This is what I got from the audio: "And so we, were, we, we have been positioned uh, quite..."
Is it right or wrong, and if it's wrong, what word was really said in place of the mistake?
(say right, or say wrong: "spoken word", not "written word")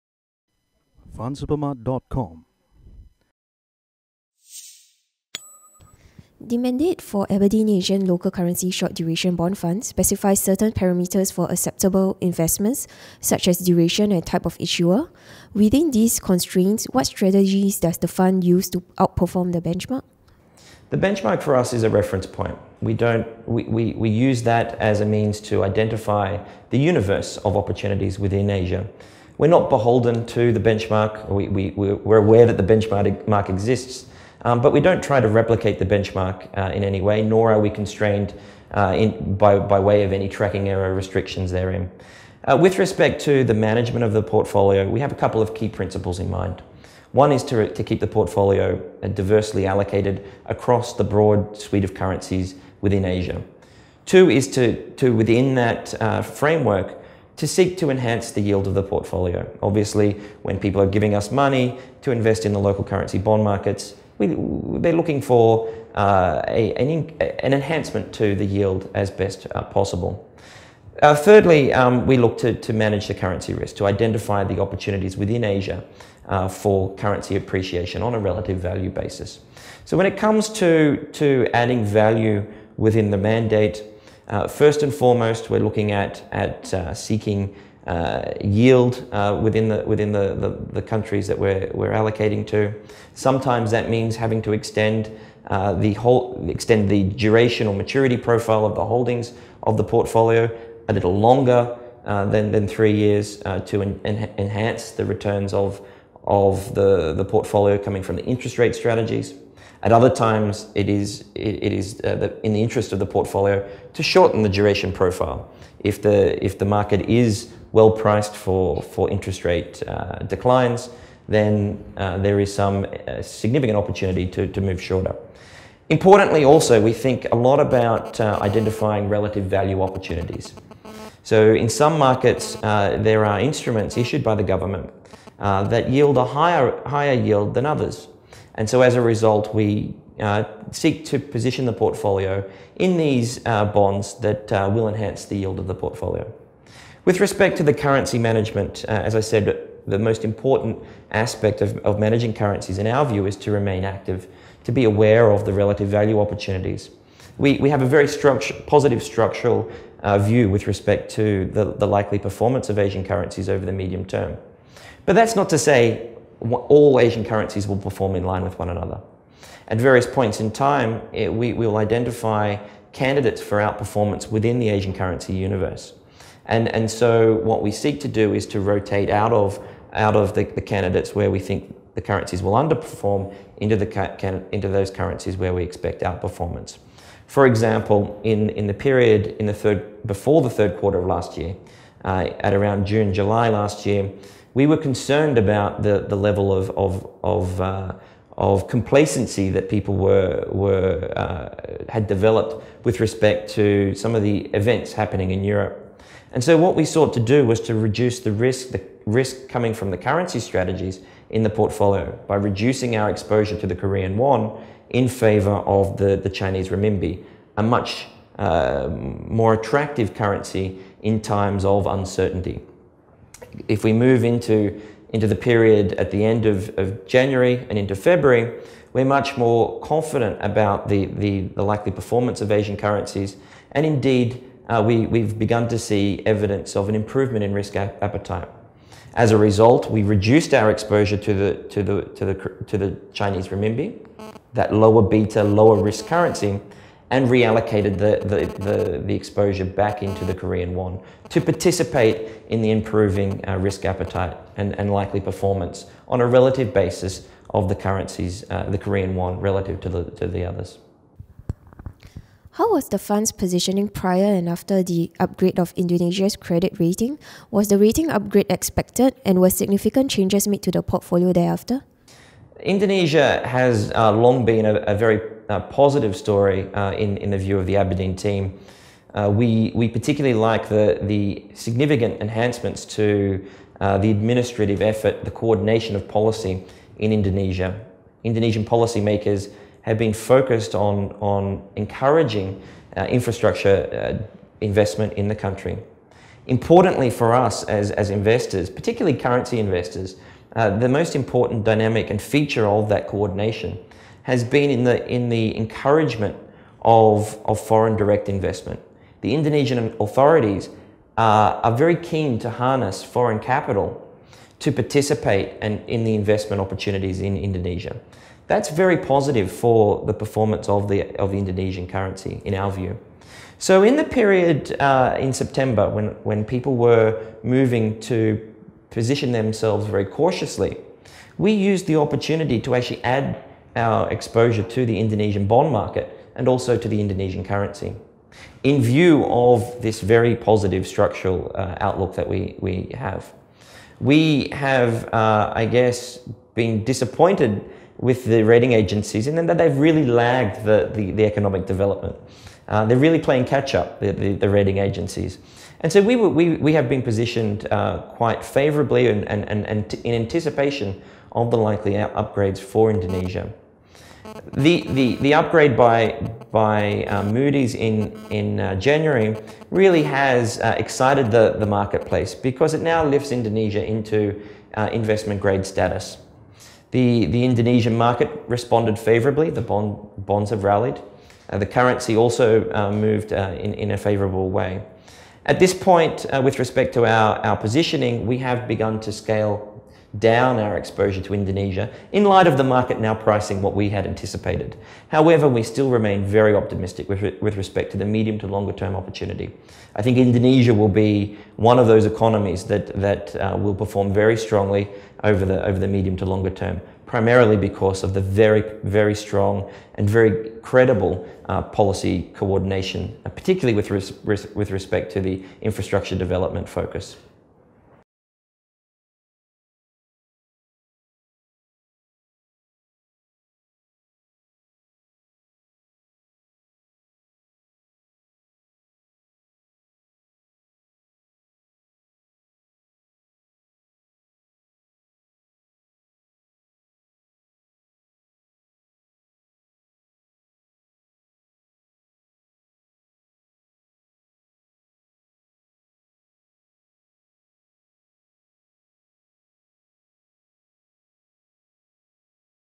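right.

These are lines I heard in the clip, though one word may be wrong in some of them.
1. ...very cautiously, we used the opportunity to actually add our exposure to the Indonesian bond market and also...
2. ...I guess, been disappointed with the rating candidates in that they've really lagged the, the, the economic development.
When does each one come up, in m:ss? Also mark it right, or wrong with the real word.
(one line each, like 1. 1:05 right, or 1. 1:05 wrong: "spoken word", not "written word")
1. 5:29 right
2. 5:45 wrong: "agencies", not "candidates".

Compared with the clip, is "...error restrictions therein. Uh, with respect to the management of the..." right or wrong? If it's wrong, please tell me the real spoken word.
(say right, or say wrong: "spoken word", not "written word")
right.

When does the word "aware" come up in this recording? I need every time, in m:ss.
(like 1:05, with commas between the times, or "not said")
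0:32, 2:34.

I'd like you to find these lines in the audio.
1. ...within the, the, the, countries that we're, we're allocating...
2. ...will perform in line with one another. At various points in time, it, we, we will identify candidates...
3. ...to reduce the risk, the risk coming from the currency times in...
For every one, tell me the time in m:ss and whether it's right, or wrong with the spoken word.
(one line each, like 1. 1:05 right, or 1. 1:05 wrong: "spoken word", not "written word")
1. 1:29 right
2. 2:47 right
3. 3:27 wrong: "strategies", not "times".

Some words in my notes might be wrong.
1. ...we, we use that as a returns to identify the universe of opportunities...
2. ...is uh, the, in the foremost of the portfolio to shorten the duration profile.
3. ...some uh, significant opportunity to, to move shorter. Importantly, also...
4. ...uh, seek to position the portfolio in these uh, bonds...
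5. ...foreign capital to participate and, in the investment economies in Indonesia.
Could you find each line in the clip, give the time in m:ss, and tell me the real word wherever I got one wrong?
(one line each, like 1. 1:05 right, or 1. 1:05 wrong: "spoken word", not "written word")
1. 0:23 wrong: "means", not "returns"
2. 1:51 wrong: "interest", not "foremost"
3. 2:02 right
4. 2:20 right
5. 5:13 wrong: "opportunities", not "economies".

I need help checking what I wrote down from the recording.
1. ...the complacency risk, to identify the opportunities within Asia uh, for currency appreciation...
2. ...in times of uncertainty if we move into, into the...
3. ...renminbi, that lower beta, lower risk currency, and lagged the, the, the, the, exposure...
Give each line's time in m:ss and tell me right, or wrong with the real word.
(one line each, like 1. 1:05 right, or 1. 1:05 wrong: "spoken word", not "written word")
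1. 1:13 wrong: "currency", not "complacency"
2. 3:41 right
3. 4:03 wrong: "reallocated", not "lagged".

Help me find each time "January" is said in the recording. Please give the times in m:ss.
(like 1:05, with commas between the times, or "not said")
3:47, 6:08.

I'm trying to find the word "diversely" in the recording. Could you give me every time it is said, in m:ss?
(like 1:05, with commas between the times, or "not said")
0:49.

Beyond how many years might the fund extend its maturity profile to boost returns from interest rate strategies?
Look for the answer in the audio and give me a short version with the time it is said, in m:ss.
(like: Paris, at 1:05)
3, at 1:42.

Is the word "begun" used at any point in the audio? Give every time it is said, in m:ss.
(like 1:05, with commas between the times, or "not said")
3:55, 6:28.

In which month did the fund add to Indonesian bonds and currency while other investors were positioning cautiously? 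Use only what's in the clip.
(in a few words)
September.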